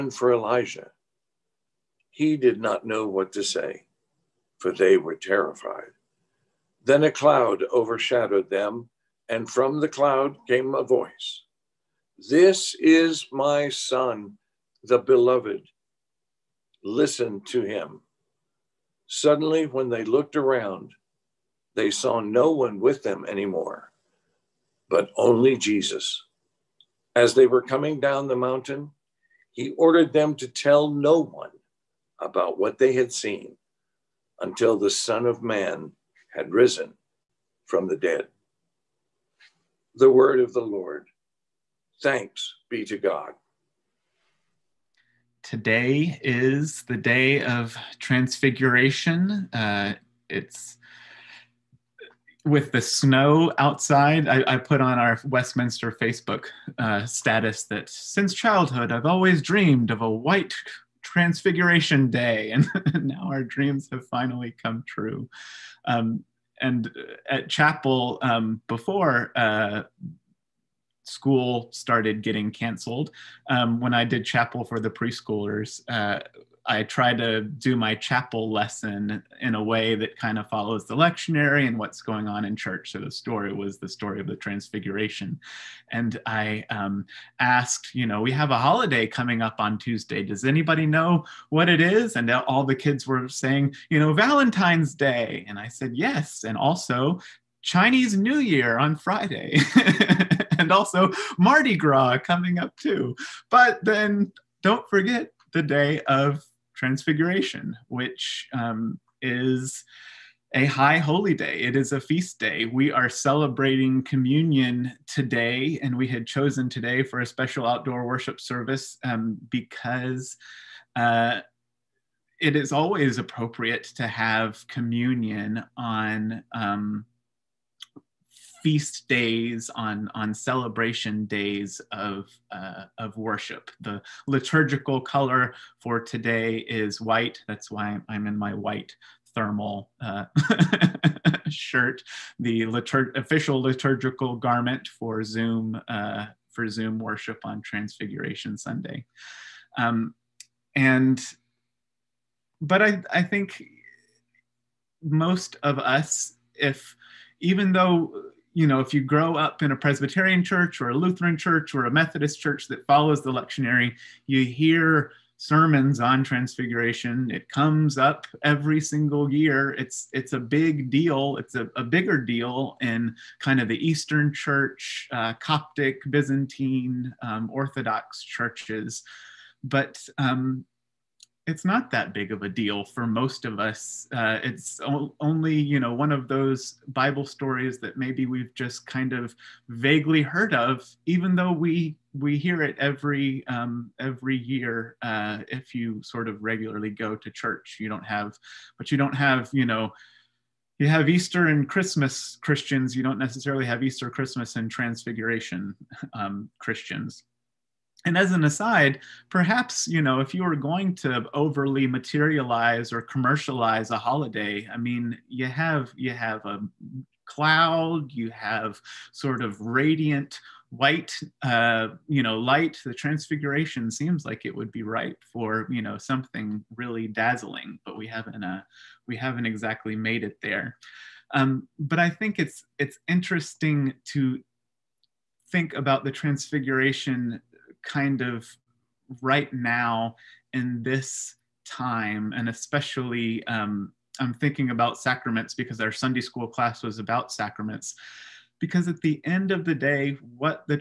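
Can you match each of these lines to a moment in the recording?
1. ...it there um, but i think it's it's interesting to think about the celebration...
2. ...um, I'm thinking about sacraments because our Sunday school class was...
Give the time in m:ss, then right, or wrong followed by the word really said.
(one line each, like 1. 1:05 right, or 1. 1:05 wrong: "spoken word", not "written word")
1. 3:50 wrong: "transfiguration", not "celebration"
2. 4:03 right.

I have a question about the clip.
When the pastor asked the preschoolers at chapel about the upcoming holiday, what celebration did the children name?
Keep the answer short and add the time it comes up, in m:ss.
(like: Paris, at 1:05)
Valentine's Day, at 1:34.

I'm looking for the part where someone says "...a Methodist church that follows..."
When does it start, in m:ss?
2:41.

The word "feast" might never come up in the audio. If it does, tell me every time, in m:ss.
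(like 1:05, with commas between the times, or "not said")
1:51, 2:08.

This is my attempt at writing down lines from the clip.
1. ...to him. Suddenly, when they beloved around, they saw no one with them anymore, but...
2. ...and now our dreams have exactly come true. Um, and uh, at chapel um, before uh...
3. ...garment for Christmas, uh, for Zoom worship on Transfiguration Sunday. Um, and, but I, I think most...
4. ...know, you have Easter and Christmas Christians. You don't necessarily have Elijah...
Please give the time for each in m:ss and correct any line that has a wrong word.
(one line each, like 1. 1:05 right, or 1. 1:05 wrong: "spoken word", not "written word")
1. 0:17 wrong: "looked", not "beloved"
2. 1:02 wrong: "finally", not "exactly"
3. 2:24 wrong: "Zoom", not "Christmas"
4. 3:19 wrong: "Easter", not "Elijah".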